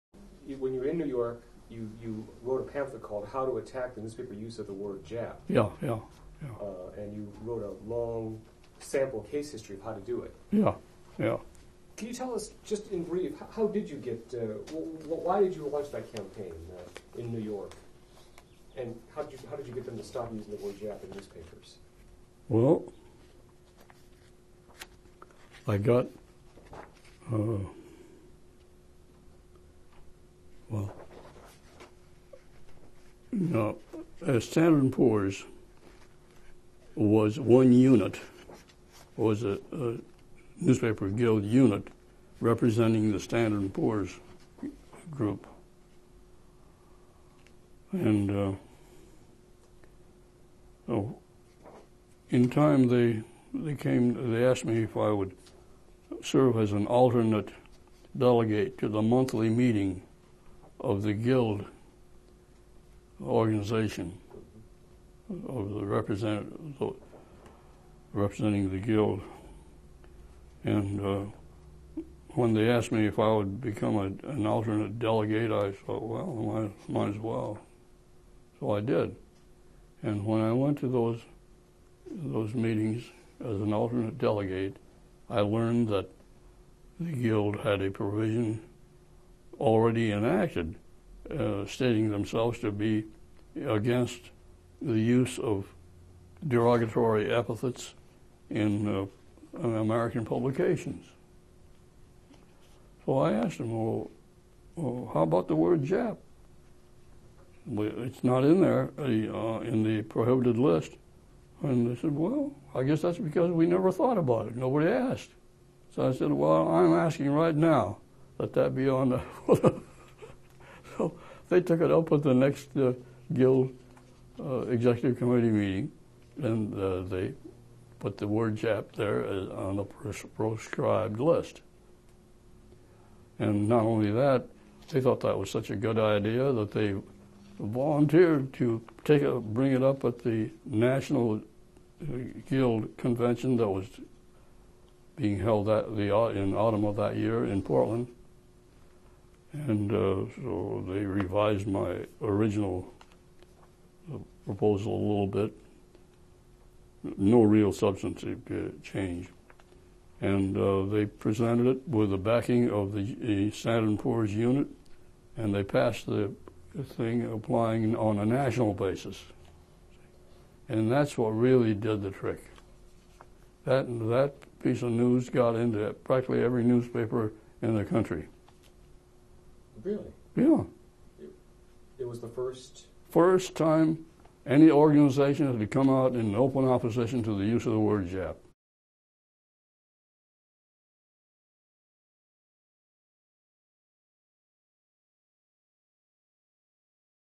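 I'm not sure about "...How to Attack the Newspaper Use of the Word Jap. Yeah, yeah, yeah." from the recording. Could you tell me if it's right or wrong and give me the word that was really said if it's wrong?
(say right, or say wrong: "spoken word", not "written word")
right.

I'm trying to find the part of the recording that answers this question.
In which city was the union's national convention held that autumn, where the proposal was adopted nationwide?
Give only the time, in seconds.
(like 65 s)
147 s.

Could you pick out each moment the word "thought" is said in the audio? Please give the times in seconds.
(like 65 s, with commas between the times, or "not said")
75 s, 113 s, 135 s.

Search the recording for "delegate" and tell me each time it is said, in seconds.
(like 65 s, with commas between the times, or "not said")
58 s, 74 s, 84 s.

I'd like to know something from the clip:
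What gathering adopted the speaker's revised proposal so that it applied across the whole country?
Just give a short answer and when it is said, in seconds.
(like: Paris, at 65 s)
National Guild Convention, at 140 s.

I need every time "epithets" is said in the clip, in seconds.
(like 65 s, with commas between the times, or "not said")
97 s.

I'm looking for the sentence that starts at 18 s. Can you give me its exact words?
And how did, you, how did you get them to stop using the word Jap in newspapers?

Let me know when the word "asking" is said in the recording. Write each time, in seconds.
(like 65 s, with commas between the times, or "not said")
116 s.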